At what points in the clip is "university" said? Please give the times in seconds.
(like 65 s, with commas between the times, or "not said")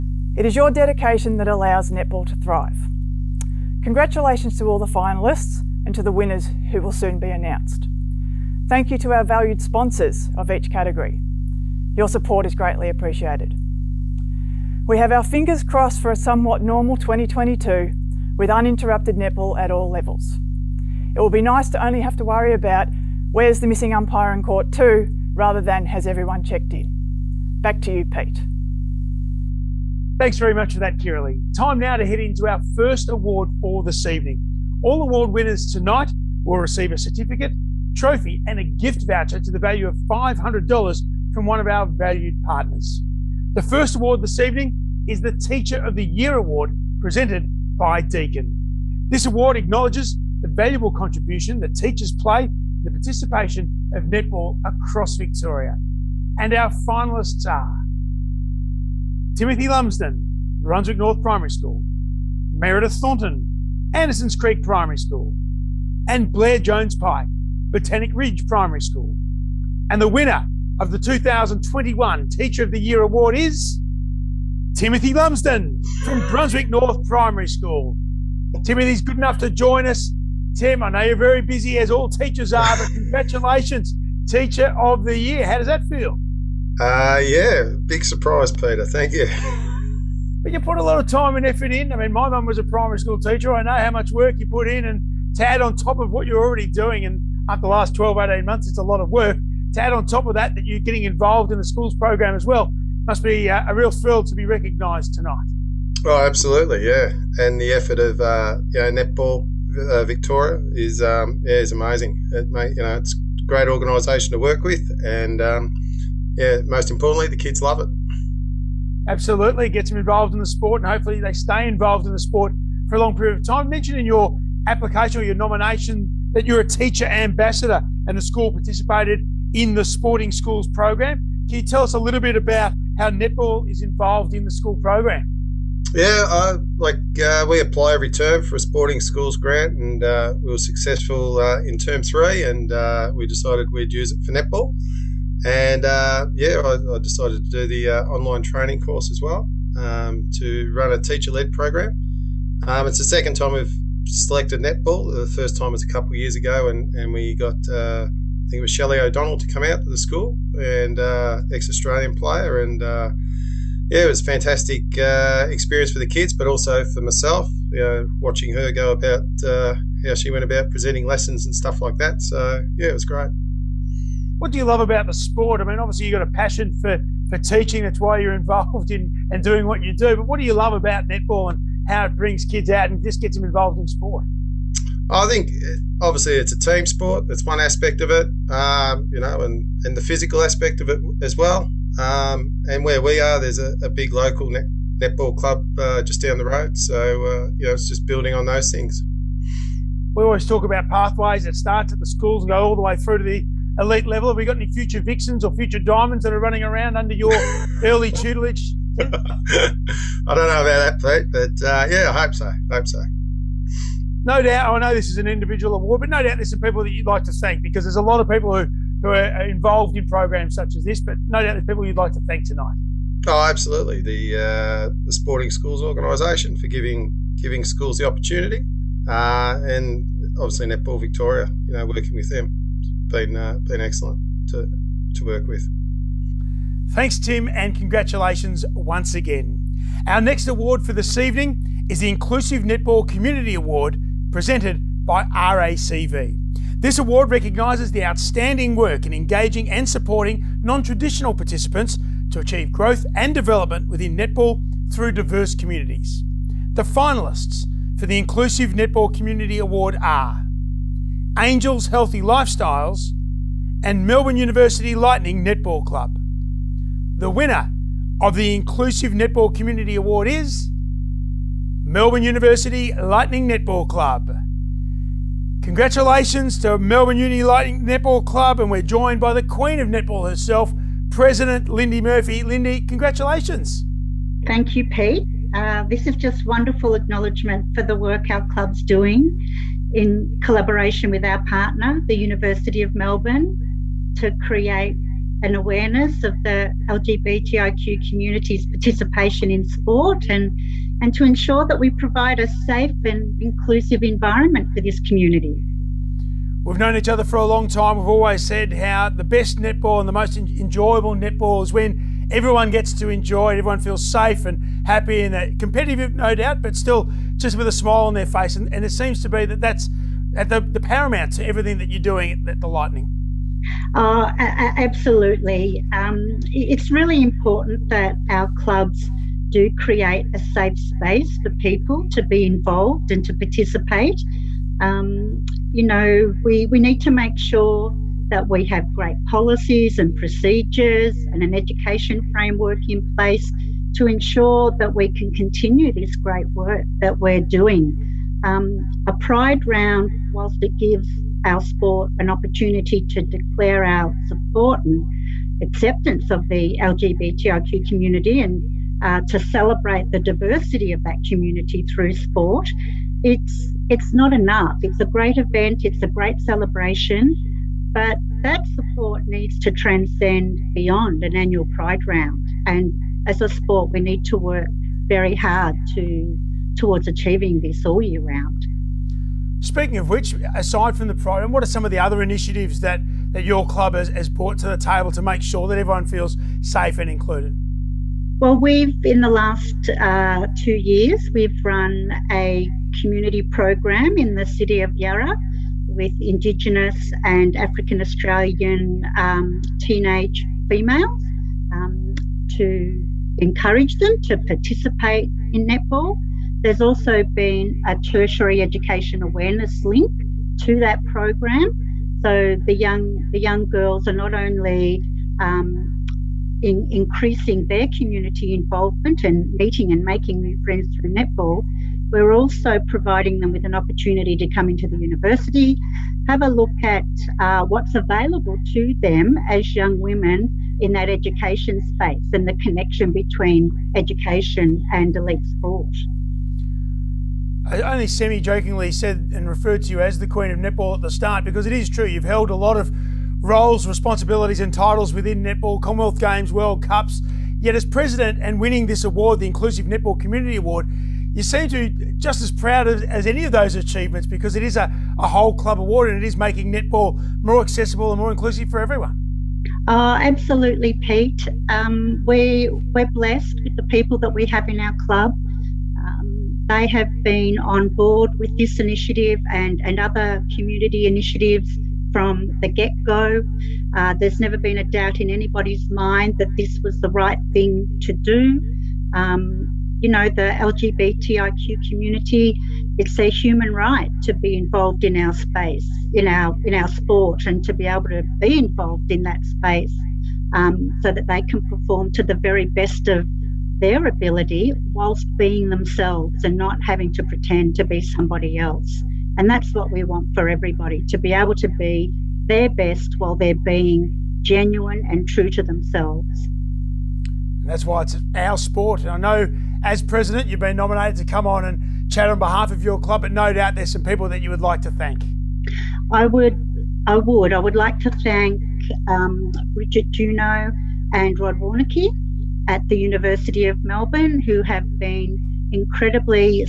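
264 s, 272 s, 292 s, 424 s, 522 s.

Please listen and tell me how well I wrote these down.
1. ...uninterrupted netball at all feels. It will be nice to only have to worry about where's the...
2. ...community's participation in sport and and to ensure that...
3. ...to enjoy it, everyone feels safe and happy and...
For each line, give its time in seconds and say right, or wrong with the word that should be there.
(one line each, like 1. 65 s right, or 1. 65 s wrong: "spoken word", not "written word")
1. 18 s wrong: "levels", not "feels"
2. 298 s right
3. 312 s right.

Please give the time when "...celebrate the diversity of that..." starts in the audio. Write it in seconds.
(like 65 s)
359 s.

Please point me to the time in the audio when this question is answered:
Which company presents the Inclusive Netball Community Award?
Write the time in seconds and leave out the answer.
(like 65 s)
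245 s.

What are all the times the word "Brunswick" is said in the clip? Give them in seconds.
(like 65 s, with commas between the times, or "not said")
60 s, 76 s.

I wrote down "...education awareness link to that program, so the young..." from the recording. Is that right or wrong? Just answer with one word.
right.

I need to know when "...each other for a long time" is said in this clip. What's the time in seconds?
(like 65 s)
306 s.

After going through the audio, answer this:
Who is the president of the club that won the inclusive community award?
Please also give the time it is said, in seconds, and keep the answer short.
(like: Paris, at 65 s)
Lindy Murphy, at 281 s.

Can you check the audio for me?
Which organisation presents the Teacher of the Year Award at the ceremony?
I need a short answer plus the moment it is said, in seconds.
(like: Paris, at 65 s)
Deakin, at 48 s.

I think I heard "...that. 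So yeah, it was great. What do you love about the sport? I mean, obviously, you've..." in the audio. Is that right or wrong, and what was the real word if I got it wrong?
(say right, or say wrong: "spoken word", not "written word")
right.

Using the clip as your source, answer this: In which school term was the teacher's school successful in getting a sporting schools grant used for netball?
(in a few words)
Term three.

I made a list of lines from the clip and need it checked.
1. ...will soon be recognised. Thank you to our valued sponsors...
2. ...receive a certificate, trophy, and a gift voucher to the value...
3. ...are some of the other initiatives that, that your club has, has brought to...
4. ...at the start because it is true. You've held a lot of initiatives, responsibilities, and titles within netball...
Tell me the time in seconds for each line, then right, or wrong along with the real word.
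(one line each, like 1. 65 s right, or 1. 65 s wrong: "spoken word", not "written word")
1. 6 s wrong: "announced", not "recognised"
2. 36 s right
3. 381 s right
4. 440 s wrong: "roles", not "initiatives".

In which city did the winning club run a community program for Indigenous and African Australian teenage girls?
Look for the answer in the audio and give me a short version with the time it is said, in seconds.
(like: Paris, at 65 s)
Yarra, at 394 s.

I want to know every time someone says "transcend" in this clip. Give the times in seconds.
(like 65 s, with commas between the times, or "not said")
369 s.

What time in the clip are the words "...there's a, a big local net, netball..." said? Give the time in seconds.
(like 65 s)
193 s.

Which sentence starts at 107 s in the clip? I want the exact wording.
And the effort of uh, you know netball uh, Victoria is um, yeah is amazing.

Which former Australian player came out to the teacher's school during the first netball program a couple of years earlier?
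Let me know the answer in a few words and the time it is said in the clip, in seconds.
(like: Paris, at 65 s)
Shelley O'Donnell, at 158 s.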